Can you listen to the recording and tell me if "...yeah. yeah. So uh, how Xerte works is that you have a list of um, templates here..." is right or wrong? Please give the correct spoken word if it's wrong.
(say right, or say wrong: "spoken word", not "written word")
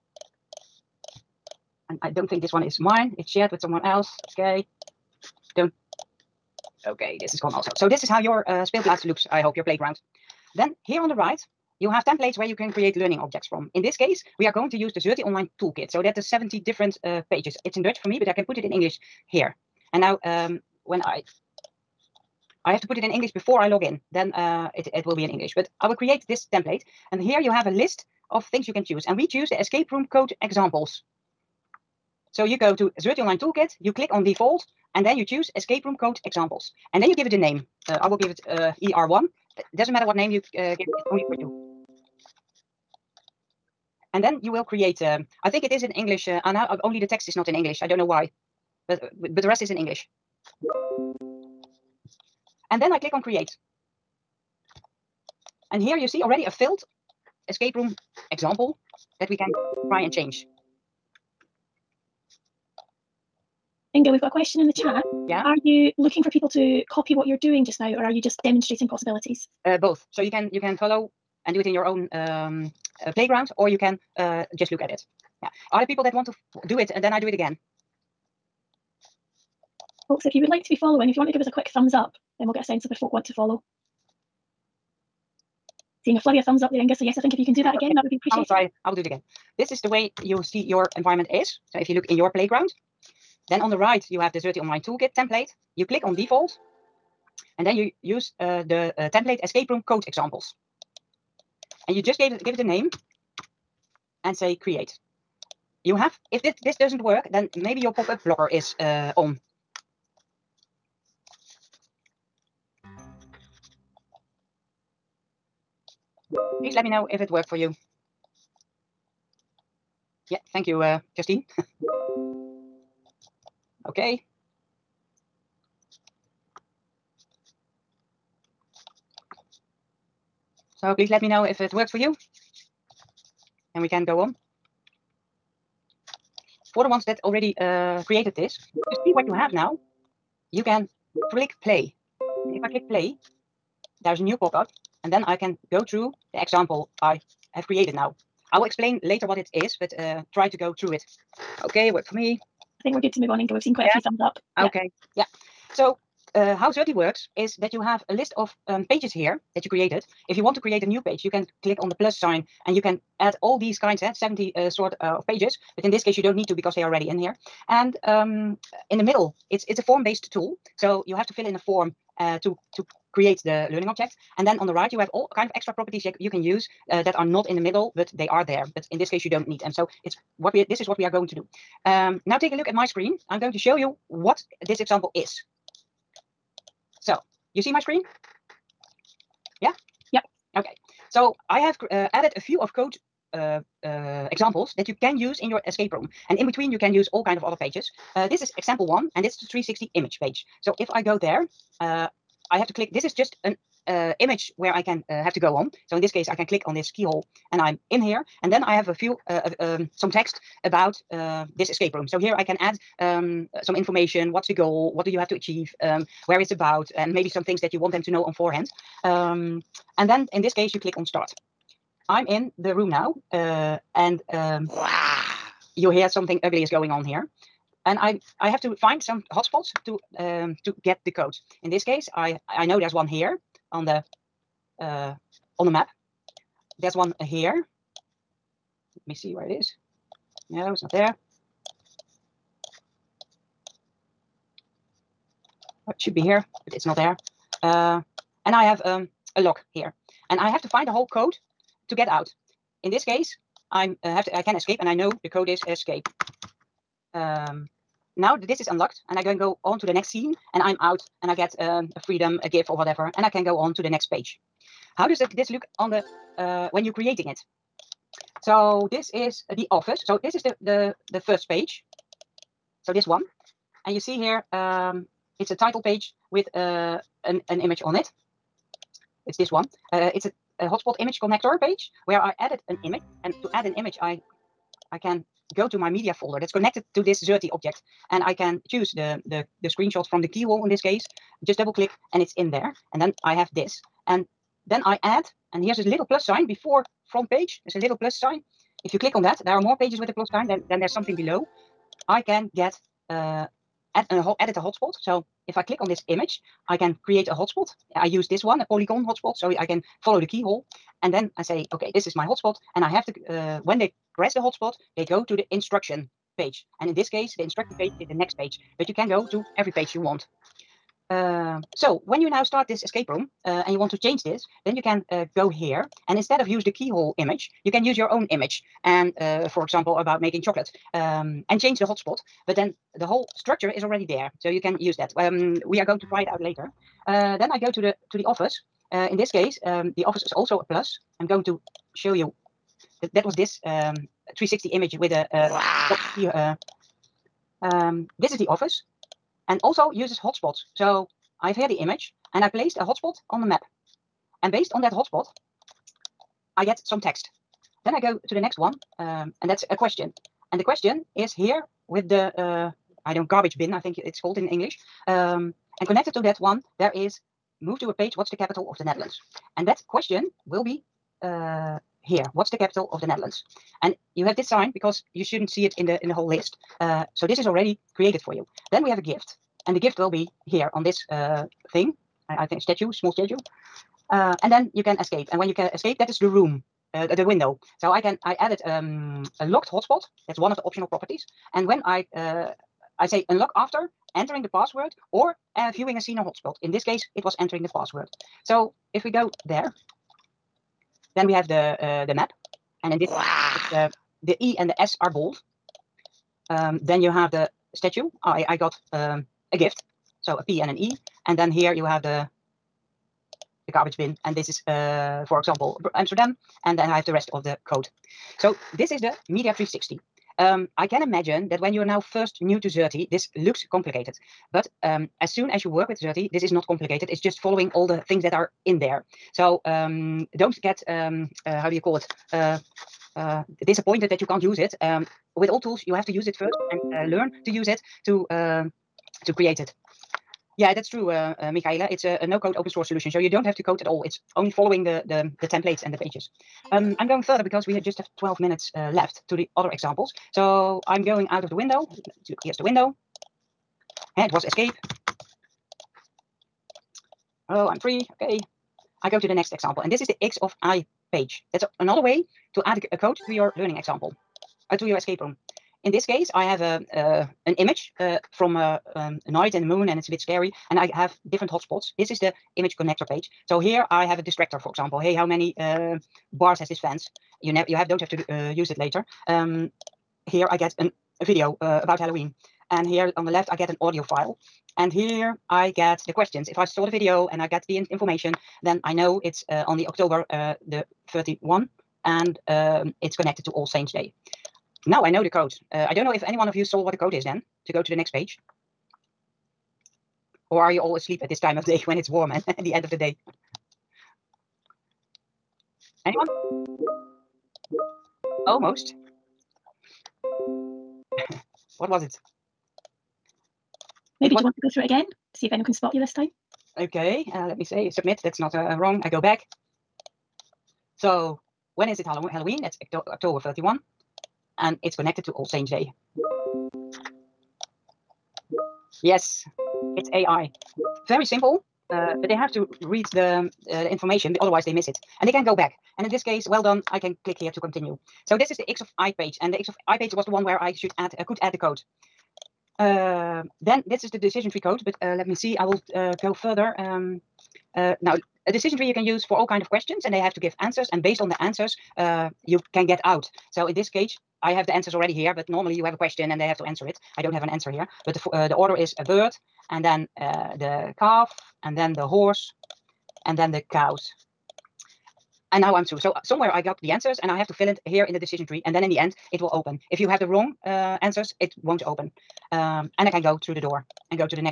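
wrong: "pages", not "templates".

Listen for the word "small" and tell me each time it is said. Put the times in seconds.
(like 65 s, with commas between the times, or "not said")
382 s.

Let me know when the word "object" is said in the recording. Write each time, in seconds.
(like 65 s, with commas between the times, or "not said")
13 s, 173 s, 287 s.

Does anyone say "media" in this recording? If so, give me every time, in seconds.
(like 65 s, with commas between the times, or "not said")
285 s, 419 s.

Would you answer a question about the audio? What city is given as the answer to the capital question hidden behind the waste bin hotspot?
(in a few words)
Amsterdam.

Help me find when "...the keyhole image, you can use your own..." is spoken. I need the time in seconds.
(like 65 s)
326 s.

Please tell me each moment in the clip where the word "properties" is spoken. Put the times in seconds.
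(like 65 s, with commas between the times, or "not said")
175 s, 390 s.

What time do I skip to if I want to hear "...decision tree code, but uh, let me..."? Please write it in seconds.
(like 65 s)
544 s.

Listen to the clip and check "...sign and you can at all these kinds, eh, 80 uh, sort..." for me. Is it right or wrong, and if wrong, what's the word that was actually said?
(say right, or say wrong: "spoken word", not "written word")
wrong: "70", not "80".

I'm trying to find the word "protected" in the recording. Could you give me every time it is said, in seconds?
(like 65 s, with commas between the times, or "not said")
not said.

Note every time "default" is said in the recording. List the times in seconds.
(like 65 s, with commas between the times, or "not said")
34 s, 96 s.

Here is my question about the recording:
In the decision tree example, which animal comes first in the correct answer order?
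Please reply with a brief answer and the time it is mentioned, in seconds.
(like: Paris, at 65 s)
a bird, at 558 s.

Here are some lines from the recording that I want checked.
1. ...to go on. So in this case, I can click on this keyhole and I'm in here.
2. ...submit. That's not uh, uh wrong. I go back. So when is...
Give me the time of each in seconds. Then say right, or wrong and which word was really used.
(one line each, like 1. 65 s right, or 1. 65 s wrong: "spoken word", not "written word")
1. 205 s right
2. 517 s right.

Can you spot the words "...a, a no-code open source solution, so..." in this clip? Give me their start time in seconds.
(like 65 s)
442 s.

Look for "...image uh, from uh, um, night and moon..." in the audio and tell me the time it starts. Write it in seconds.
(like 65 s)
467 s.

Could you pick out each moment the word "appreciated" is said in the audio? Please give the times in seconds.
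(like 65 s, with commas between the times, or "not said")
88 s.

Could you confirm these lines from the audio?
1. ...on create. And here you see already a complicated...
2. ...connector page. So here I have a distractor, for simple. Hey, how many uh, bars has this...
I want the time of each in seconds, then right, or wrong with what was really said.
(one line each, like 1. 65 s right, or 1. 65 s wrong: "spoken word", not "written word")
1. 53 s wrong: "filled", not "complicated"
2. 472 s wrong: "example", not "simple".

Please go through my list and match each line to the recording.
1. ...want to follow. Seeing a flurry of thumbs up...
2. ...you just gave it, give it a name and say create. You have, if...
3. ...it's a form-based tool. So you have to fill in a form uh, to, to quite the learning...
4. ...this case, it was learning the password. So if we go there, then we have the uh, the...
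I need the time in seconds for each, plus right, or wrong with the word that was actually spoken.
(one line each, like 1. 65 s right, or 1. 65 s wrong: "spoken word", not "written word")
1. 83 s right
2. 101 s right
3. 169 s wrong: "create", not "quite"
4. 396 s wrong: "entering", not "learning".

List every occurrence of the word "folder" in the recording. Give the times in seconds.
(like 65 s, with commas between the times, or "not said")
286 s.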